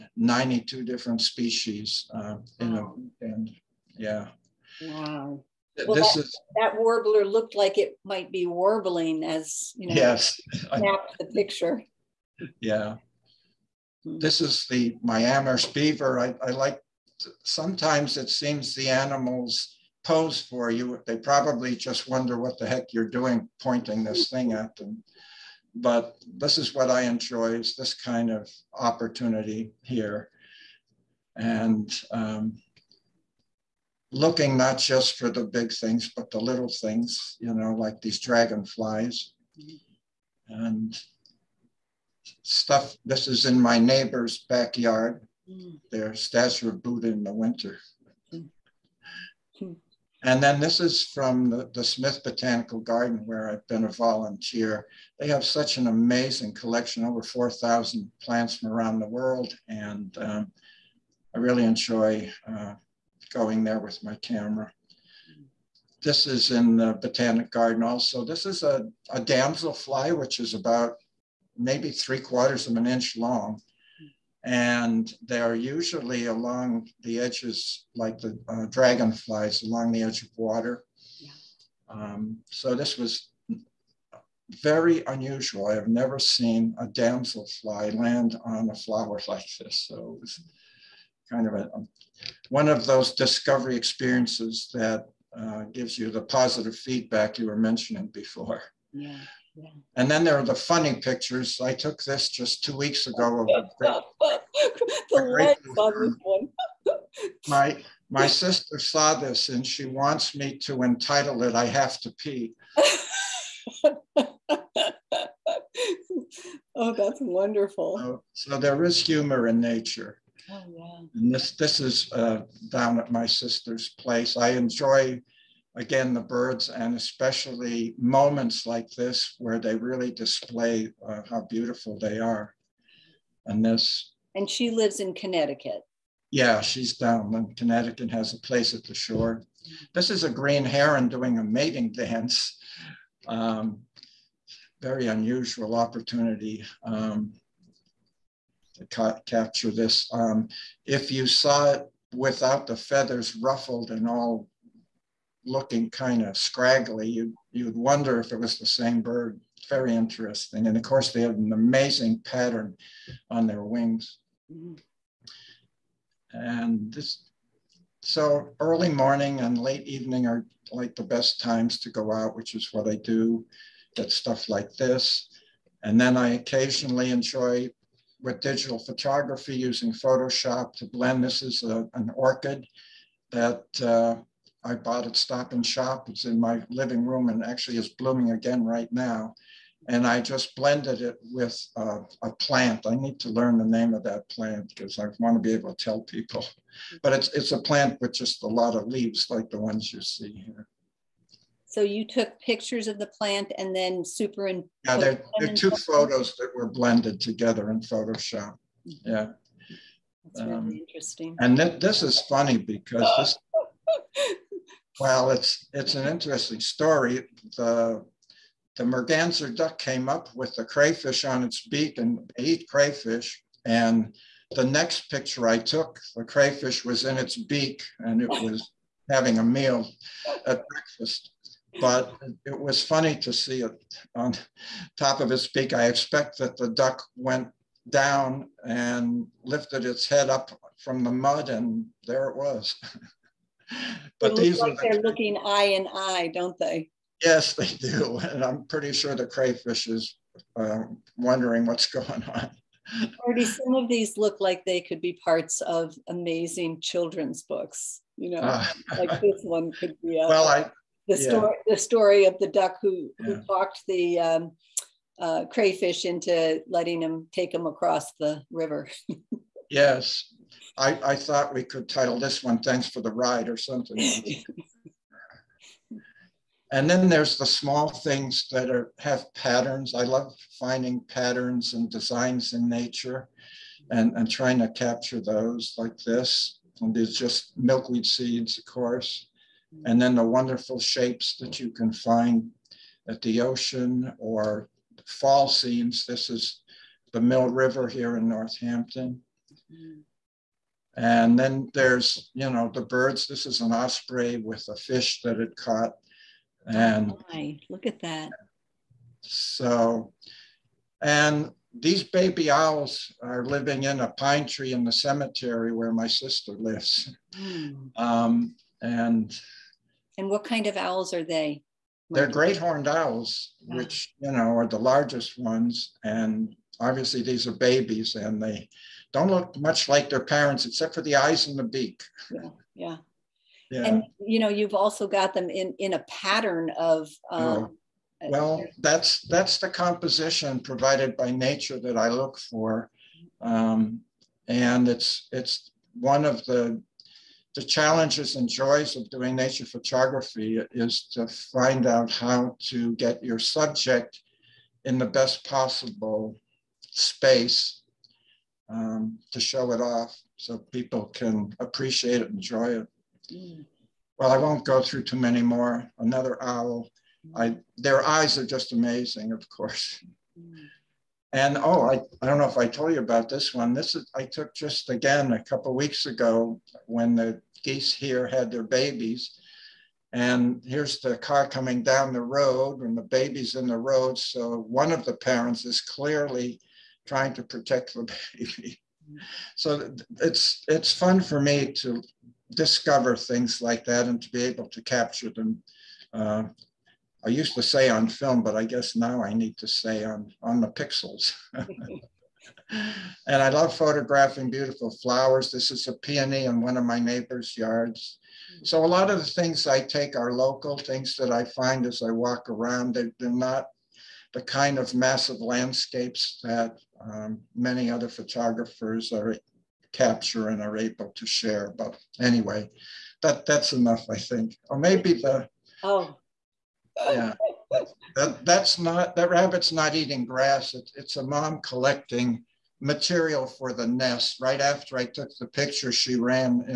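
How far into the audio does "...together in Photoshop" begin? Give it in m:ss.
3:27.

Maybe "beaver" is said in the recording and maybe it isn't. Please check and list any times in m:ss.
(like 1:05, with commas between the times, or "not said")
0:15.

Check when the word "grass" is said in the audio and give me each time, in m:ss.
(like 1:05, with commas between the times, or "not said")
7:10.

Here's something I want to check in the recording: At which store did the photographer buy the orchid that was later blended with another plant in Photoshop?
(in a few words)
Stop and Shop.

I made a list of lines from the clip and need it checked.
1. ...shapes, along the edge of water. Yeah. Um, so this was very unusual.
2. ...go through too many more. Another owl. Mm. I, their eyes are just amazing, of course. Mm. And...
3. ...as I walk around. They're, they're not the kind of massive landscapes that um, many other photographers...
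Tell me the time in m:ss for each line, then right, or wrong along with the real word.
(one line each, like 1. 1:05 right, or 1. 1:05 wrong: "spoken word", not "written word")
1. 1:18 wrong: "dragonflies", not "shapes"
2. 6:04 right
3. 6:51 right.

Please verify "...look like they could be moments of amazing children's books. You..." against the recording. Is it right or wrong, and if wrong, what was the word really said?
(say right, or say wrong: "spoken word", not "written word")
wrong: "parts", not "moments".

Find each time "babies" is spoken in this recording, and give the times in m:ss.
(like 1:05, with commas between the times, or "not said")
5:27, 6:18.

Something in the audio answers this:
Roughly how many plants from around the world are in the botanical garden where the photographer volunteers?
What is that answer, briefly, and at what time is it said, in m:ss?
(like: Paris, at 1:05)
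over 4,000, at 0:57.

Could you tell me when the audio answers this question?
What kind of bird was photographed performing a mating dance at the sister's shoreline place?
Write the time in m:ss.
2:20.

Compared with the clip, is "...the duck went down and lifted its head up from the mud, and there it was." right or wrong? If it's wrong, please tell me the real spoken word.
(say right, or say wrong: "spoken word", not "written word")
right.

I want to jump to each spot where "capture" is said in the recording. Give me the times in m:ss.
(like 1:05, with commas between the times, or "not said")
2:29, 4:44, 6:34, 6:59.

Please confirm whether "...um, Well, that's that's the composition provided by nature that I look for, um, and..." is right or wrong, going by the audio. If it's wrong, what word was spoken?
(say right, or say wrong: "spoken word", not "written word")
right.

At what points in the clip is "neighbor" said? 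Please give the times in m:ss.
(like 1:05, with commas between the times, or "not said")
0:43, 6:46.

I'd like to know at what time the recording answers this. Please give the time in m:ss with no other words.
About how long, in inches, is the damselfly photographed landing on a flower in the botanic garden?
1:11.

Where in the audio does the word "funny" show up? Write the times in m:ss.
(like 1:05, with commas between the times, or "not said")
1:40, 3:32, 3:52.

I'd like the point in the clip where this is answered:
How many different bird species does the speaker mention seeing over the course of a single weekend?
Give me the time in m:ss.
0:00.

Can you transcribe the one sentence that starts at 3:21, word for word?
So you took pictures of the plant and then superimposed.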